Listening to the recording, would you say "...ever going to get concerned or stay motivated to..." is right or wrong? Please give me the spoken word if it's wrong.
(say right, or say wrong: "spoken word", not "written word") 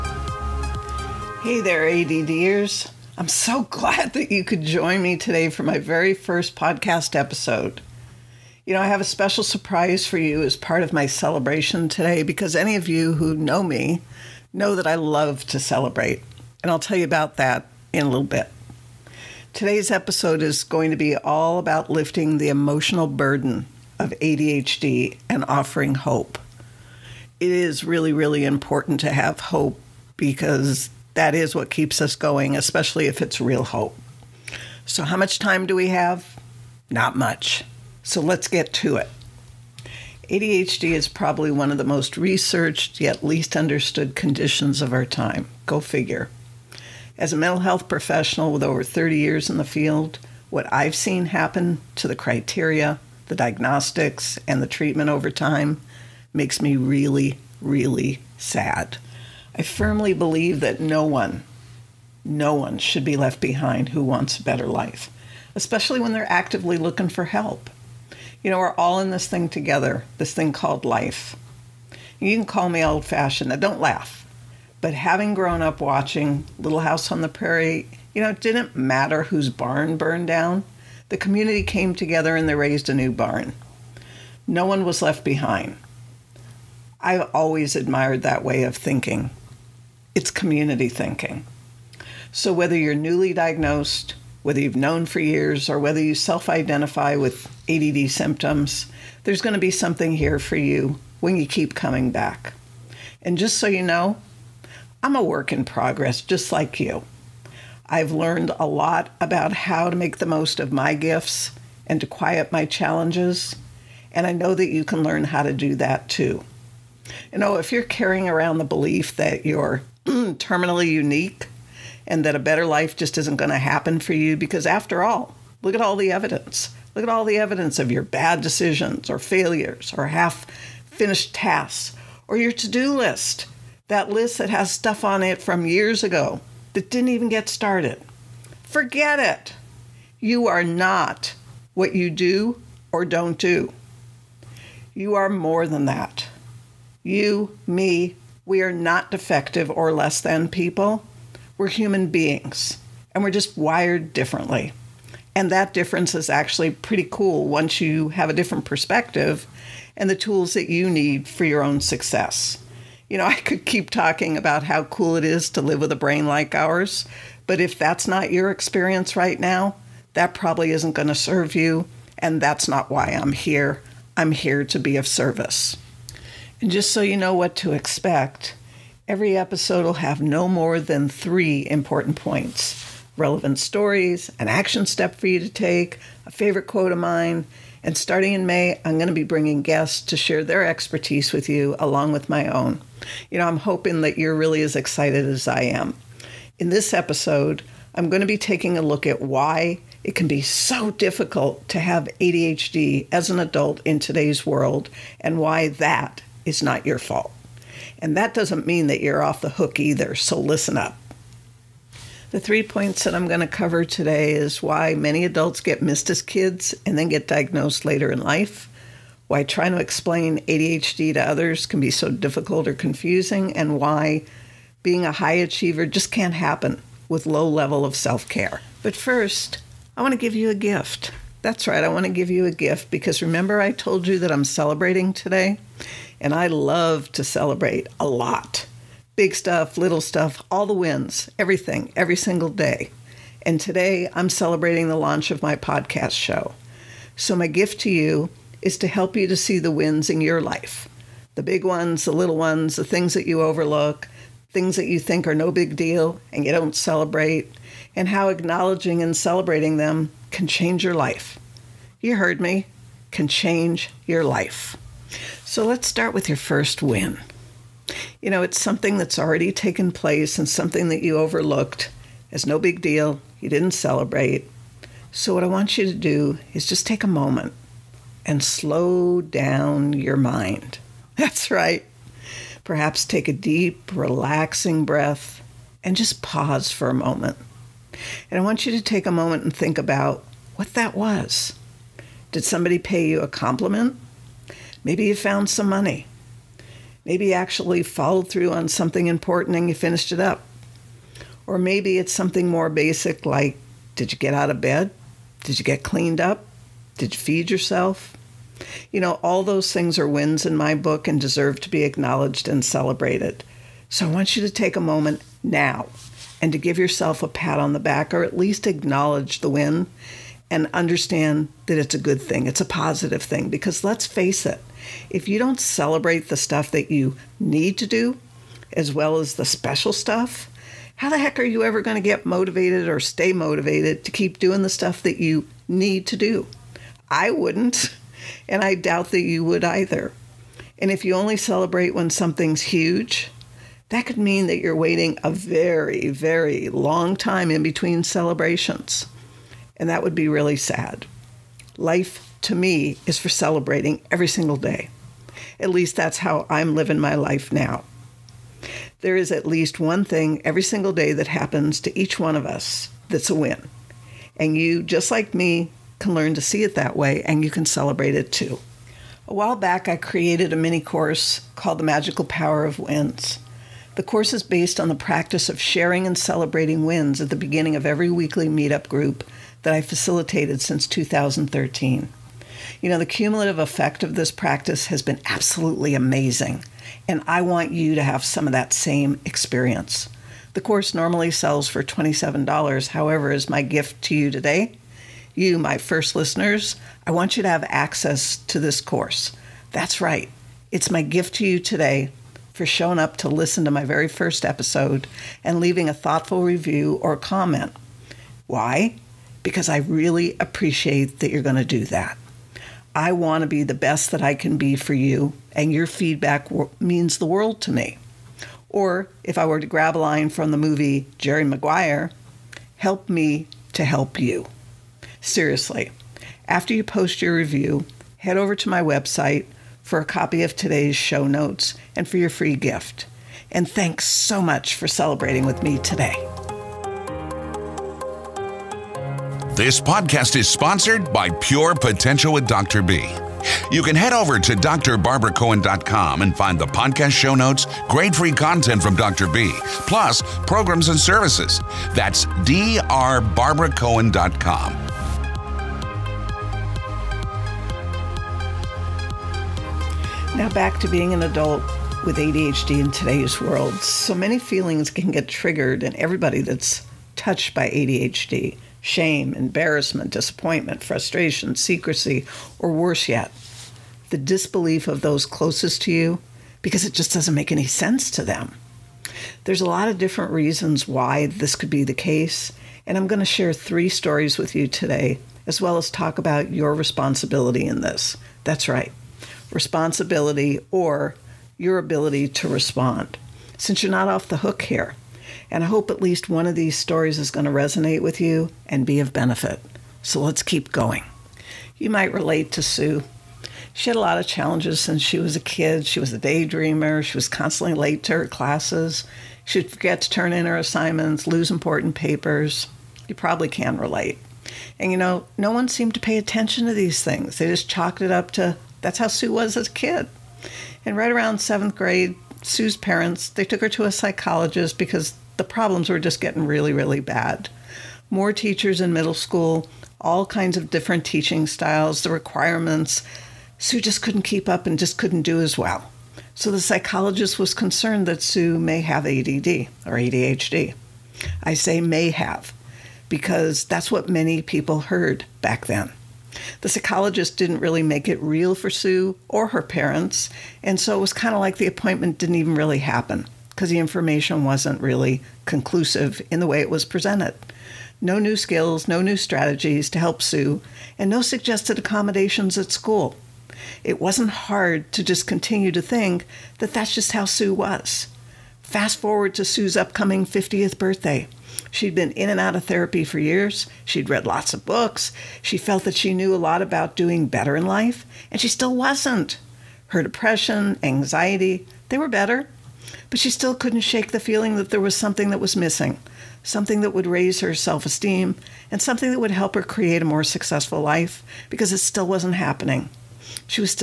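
wrong: "motivated", not "concerned".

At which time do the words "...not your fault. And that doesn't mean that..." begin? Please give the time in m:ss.
3:26.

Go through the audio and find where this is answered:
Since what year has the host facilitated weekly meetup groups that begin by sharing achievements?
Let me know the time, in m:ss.
6:20.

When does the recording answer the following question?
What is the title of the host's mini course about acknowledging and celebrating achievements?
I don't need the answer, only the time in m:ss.
6:11.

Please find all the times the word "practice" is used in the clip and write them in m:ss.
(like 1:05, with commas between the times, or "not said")
6:14, 6:24.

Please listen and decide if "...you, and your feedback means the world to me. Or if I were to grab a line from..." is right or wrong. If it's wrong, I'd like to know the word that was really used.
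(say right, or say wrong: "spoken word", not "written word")
right.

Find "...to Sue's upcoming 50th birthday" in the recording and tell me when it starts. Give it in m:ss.
9:29.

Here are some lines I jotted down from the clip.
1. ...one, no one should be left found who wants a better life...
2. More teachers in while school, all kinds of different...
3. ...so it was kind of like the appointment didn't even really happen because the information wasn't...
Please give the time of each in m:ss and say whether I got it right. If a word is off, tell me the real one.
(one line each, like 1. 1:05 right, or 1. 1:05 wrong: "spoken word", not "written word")
1. 1:01 wrong: "behind", not "found"
2. 8:48 wrong: "middle", not "while"
3. 9:10 right.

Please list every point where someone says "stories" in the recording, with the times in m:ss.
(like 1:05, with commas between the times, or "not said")
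3:03, 8:03, 8:16.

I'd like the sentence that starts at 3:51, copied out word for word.
That's right, I want to give you a gift because remember I told you that I'm celebrating today?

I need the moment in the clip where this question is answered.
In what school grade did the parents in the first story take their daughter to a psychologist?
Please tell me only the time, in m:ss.
8:41.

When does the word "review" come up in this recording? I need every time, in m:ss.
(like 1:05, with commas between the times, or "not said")
6:46, 7:07.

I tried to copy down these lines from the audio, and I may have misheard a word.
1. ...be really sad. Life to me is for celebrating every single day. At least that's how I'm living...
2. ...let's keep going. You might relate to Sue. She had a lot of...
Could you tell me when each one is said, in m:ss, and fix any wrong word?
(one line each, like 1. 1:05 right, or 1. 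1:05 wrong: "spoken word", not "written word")
1. 5:50 right
2. 8:20 right.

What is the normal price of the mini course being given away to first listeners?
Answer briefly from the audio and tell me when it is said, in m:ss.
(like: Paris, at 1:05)
$27, at 6:31.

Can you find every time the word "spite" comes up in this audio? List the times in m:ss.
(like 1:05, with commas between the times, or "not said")
not said.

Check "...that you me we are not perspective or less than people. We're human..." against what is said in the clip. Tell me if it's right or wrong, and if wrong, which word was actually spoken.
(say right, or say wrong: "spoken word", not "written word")
wrong: "defective", not "perspective".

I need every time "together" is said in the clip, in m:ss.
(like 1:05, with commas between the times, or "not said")
1:09, 1:21.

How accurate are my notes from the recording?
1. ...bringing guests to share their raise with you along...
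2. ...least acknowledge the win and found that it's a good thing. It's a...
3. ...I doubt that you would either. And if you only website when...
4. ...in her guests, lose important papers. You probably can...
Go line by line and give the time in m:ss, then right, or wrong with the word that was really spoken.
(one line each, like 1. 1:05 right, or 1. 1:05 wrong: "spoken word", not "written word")
1. 3:09 wrong: "expertise", not "raise"
2. 5:18 wrong: "understand", not "found"
3. 5:38 wrong: "celebrate", not "website"
4. 8:30 wrong: "assignments", not "guests".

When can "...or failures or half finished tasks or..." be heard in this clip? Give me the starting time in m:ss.
2:09.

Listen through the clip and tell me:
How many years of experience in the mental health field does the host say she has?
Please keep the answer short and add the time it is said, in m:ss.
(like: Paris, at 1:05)
30, at 0:48.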